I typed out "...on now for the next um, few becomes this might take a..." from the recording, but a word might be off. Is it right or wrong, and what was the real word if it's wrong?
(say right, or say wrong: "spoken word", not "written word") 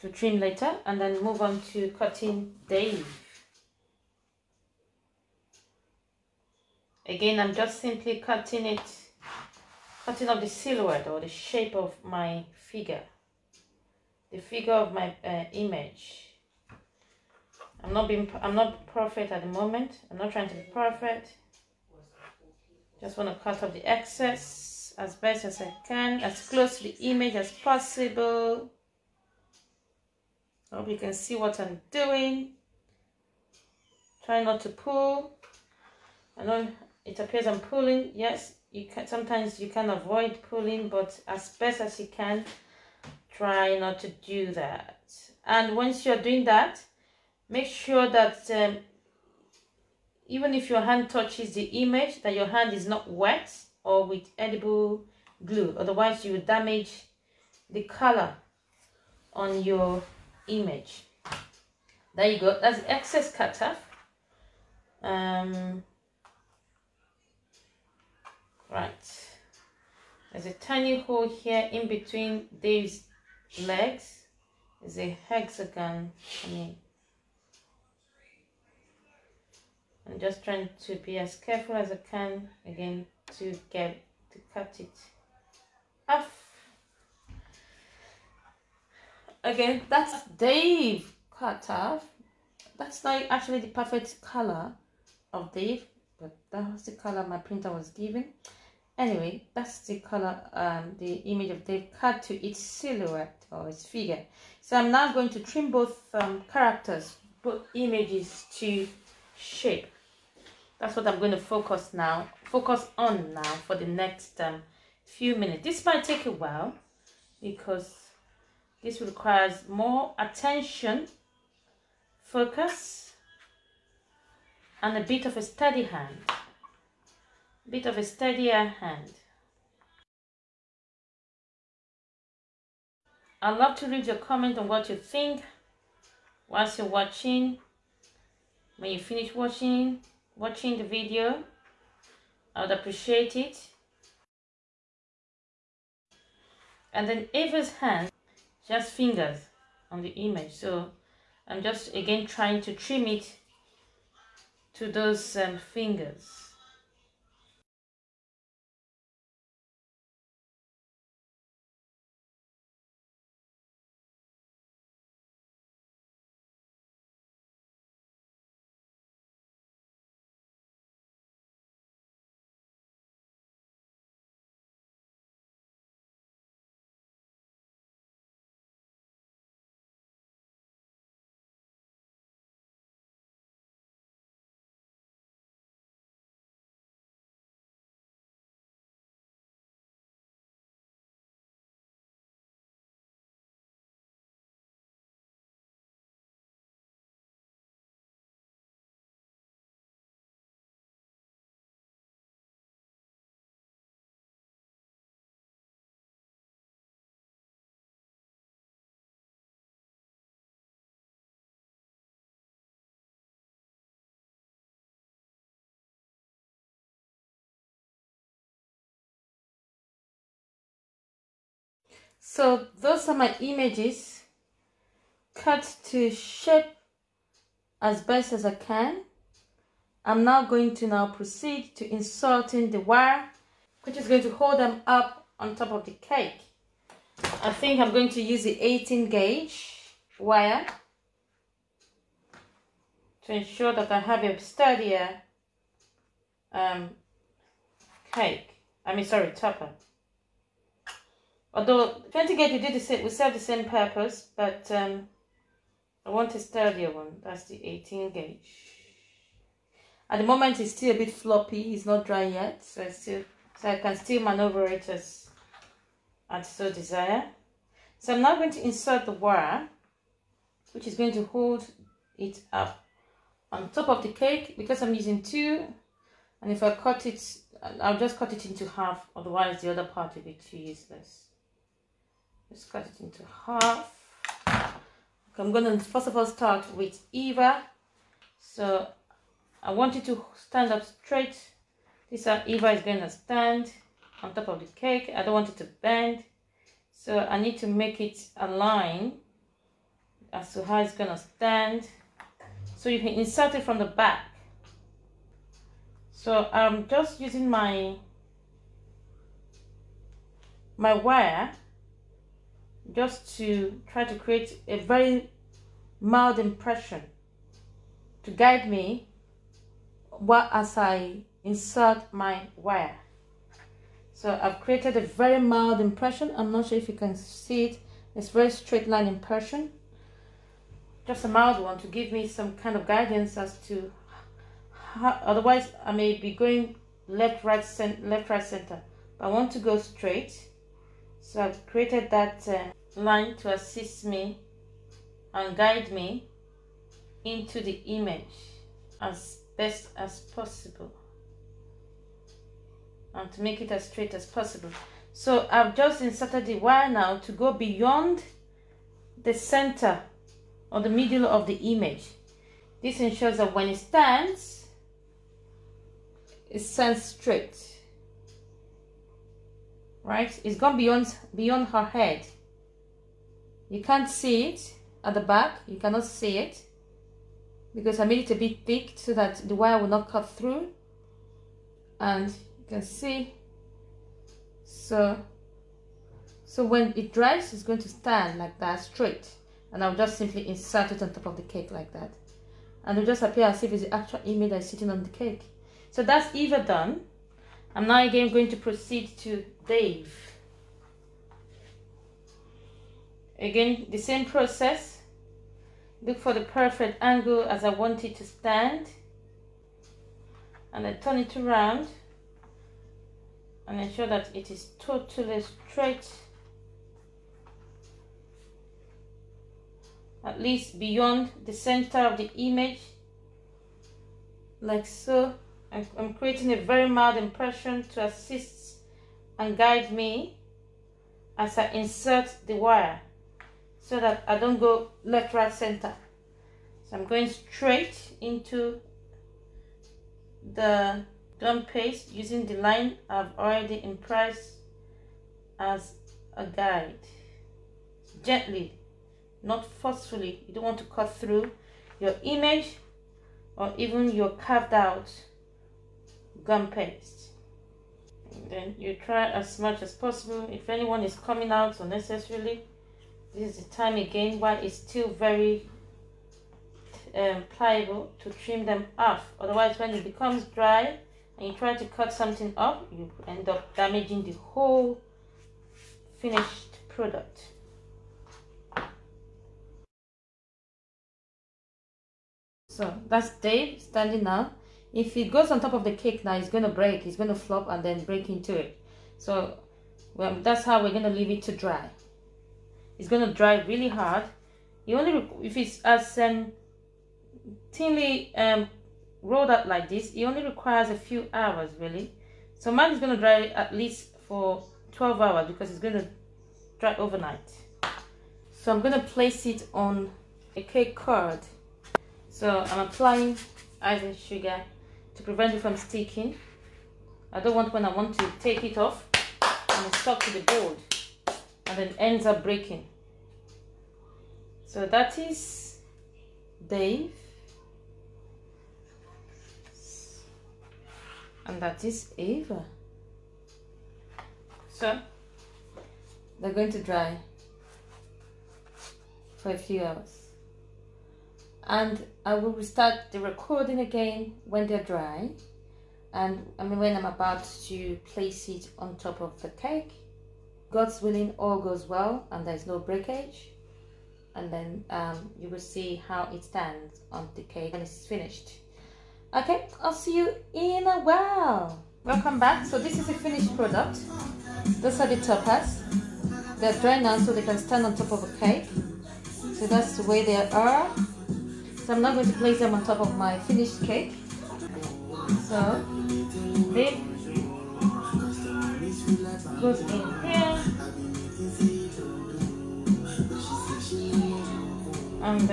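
wrong: "minutes", not "becomes".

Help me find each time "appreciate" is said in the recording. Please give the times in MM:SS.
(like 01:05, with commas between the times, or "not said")
02:22.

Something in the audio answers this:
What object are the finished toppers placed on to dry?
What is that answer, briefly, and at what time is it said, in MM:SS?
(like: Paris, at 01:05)
cake card, at 08:30.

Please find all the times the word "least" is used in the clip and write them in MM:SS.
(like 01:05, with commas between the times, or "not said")
07:00, 08:23.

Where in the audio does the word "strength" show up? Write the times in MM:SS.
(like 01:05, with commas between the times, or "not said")
not said.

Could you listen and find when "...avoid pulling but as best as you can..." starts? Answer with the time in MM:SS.
00:39.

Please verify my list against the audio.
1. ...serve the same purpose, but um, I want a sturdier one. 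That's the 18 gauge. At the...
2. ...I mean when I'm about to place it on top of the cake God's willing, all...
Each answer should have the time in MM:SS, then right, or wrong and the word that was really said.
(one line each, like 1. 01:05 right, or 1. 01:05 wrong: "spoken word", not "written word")
1. 04:13 right
2. 09:06 right.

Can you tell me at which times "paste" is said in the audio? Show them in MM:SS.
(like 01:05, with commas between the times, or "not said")
07:21, 07:36.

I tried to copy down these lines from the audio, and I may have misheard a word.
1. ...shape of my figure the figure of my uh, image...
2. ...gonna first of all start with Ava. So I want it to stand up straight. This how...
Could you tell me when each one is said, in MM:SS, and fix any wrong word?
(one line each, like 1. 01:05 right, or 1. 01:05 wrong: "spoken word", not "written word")
1. 00:11 right
2. 04:45 wrong: "Eva", not "Ava".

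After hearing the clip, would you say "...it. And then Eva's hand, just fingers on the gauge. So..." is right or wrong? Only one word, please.
wrong.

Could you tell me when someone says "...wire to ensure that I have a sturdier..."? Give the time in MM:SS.
04:00.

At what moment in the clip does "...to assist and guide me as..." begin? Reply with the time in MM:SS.
07:07.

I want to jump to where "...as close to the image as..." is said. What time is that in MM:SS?
00:26.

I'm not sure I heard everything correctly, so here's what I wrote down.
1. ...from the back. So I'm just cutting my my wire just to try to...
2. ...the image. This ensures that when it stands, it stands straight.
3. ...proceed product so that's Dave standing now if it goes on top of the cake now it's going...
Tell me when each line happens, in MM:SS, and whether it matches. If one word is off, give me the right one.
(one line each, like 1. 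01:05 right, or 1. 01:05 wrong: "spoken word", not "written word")
1. 05:03 wrong: "using", not "cutting"
2. 06:01 right
3. 07:56 wrong: "finished", not "proceed".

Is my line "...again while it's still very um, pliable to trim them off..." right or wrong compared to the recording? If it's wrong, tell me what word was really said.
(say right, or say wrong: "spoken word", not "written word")
right.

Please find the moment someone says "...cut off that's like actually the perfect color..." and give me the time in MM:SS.
01:31.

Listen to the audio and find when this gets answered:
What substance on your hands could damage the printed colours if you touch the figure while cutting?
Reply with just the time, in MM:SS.
00:54.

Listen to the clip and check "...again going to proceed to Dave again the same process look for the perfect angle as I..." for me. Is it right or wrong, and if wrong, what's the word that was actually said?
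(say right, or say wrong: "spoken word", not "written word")
right.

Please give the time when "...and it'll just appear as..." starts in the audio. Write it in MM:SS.
06:32.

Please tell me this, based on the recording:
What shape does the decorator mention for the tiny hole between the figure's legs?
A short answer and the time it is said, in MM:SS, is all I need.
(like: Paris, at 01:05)
hexagon, at 01:15.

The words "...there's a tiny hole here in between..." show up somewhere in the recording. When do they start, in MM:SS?
01:10.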